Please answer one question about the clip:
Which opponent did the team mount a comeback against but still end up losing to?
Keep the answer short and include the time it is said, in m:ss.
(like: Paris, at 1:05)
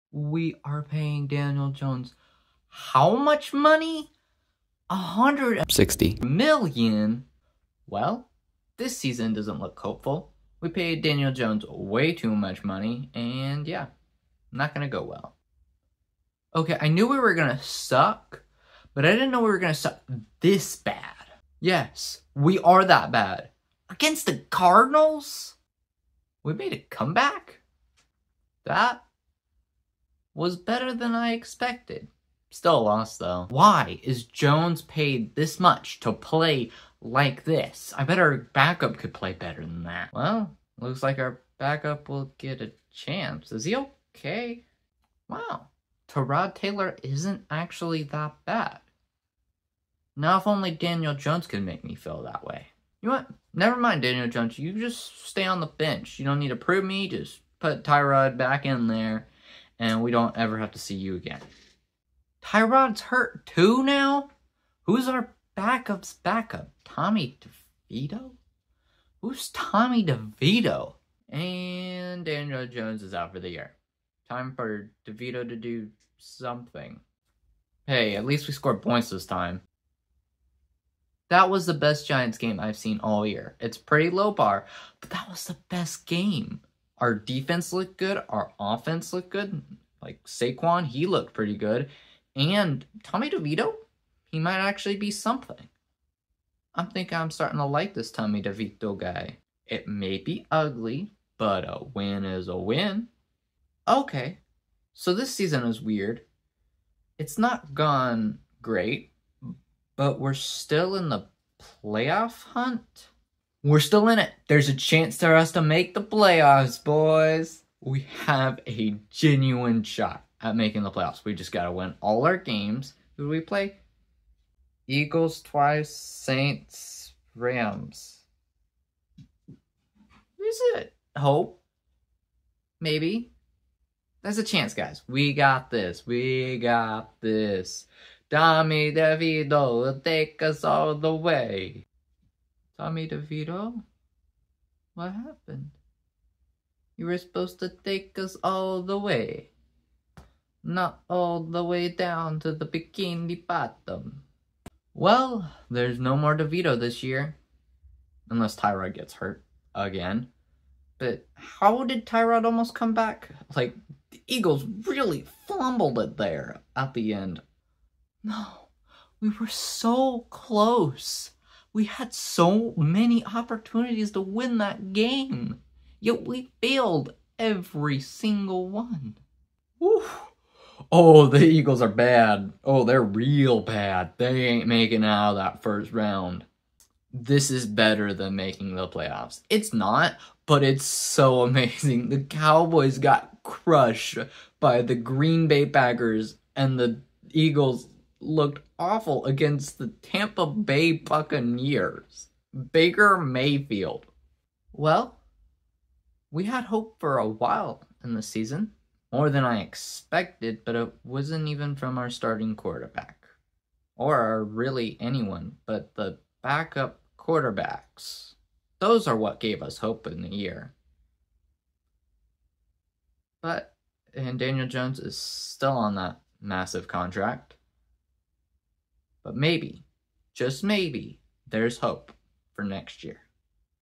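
Cardinals, at 0:24.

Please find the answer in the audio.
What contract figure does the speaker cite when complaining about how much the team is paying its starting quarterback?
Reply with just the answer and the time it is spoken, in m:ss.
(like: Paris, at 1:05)
160 million, at 0:04.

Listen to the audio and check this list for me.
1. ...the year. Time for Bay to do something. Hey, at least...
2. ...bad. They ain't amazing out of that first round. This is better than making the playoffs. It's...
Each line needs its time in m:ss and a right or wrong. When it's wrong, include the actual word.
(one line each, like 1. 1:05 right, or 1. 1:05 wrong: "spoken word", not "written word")
1. 1:13 wrong: "DeVito", not "Bay"
2. 3:03 wrong: "making", not "amazing".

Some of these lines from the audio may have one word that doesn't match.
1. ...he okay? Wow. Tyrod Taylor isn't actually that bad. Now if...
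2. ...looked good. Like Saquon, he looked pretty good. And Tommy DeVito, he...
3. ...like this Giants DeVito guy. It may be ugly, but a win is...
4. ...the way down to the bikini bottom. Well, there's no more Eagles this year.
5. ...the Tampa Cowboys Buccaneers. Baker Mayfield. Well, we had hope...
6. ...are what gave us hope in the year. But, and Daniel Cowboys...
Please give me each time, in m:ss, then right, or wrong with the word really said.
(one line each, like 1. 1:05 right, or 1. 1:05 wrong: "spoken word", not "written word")
1. 0:43 right
2. 1:29 right
3. 1:37 wrong: "Tommy", not "Giants"
4. 2:31 wrong: "DeVito", not "Eagles"
5. 3:19 wrong: "Bay", not "Cowboys"
6. 3:39 wrong: "Jones", not "Cowboys".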